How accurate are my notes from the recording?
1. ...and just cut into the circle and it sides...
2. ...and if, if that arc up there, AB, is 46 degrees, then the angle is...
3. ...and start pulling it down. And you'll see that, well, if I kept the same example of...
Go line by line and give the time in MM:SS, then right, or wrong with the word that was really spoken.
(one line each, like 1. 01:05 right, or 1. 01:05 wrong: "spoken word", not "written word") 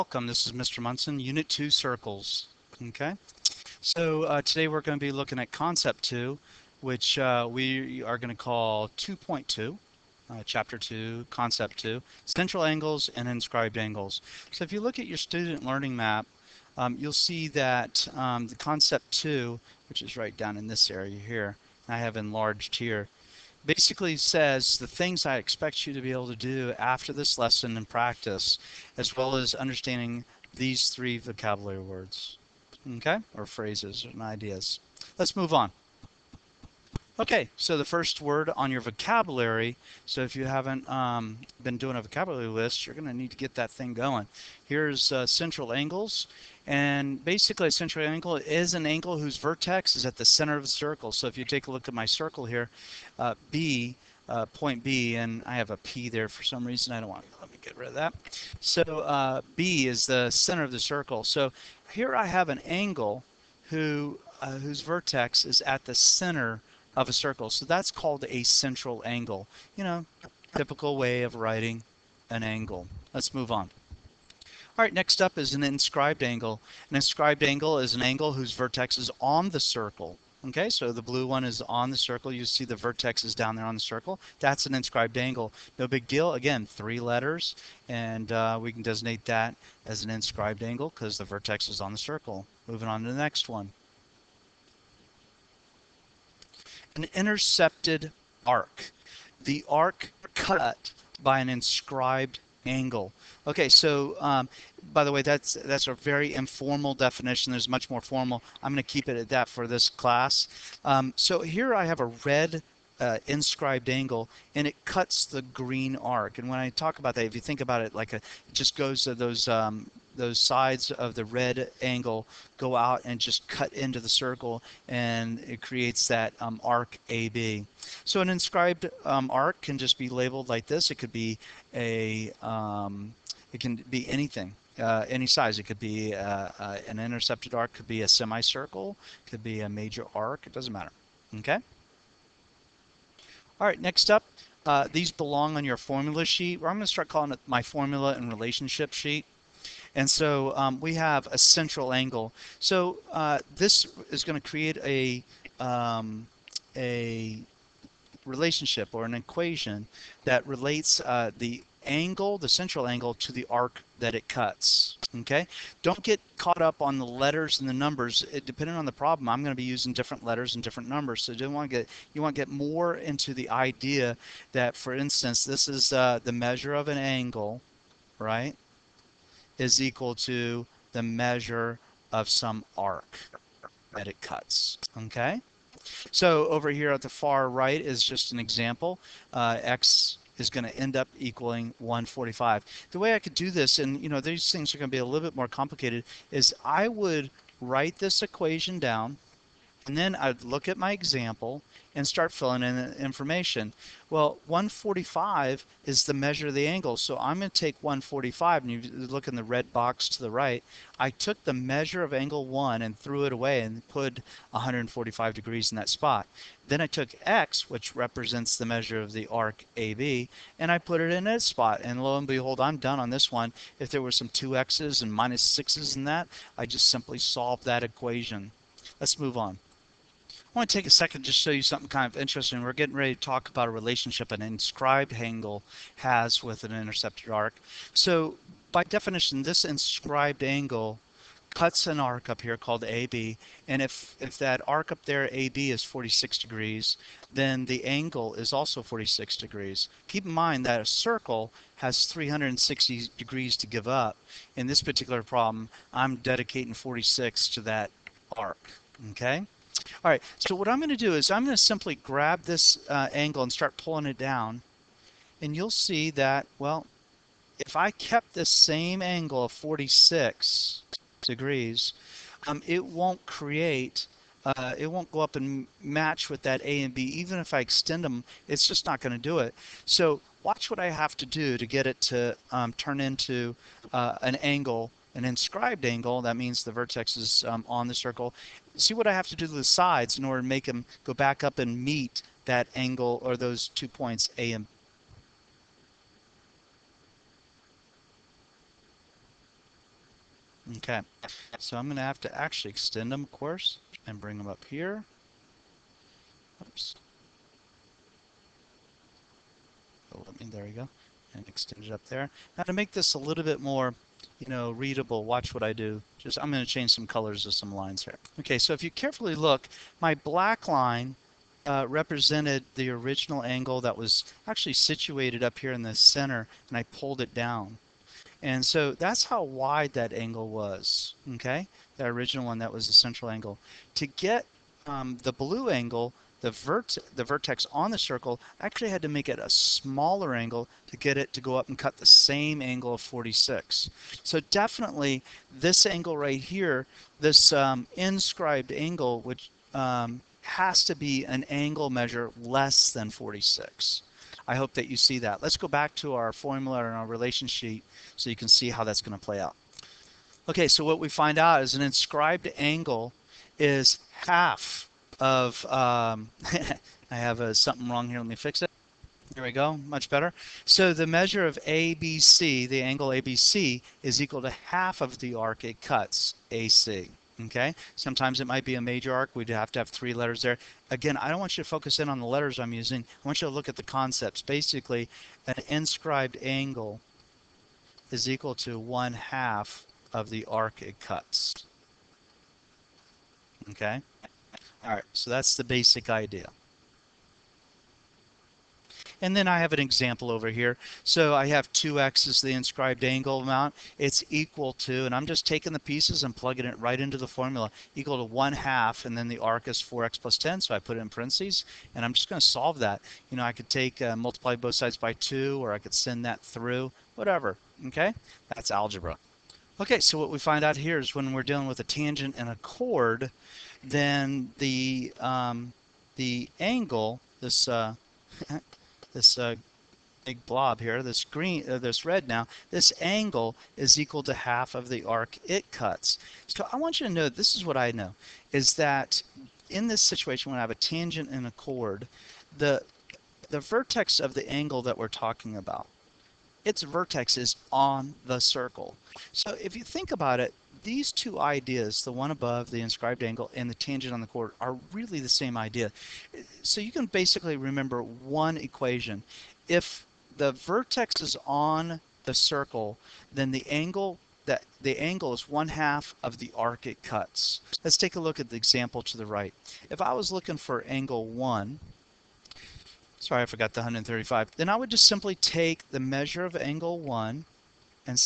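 1. 02:03 wrong: "creates", not "sides"
2. 04:03 right
3. 04:23 wrong: "angle", not "example".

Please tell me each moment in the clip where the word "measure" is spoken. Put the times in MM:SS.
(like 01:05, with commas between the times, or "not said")
02:56, 03:01, 03:26, 03:31, 03:38, 05:51, 06:11, 07:56.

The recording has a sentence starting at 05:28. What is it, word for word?
And so that's how wide that angle was, okay?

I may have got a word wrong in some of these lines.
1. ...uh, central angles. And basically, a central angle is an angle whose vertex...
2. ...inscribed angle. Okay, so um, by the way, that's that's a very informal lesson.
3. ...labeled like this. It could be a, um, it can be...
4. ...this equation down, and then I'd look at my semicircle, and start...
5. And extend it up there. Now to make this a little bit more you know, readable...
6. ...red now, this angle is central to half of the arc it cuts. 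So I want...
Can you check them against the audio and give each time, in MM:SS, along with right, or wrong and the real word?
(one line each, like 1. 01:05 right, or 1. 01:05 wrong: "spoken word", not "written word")
1. 00:45 right
2. 01:41 wrong: "definition", not "lesson"
3. 02:10 right
4. 03:17 wrong: "example", not "semicircle"
5. 05:11 right
6. 07:12 wrong: "equal", not "central".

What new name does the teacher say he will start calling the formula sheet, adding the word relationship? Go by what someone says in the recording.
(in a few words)
formula and relationship sheet.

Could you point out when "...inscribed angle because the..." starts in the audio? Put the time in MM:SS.
01:30.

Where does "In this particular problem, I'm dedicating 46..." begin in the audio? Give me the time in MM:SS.
04:14.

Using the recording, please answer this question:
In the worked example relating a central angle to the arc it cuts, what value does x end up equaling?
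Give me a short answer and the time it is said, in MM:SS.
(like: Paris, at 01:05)
145, at 03:09.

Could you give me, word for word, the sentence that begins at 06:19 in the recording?
We'd have to have three letters there.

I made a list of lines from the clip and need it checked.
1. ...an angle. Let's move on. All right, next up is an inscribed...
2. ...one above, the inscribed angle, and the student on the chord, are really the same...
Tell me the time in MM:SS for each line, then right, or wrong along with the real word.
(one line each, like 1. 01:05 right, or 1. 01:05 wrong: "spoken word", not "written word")
1. 01:12 right
2. 07:32 wrong: "tangent", not "student".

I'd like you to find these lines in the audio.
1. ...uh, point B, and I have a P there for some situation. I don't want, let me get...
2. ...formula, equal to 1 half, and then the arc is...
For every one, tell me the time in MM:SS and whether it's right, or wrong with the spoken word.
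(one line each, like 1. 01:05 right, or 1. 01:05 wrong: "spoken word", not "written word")
1. 00:54 wrong: "reason", not "situation"
2. 06:47 right.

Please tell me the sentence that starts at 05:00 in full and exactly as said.
Okay, so I'm going to have to actually extend them, of course, and bring them up here.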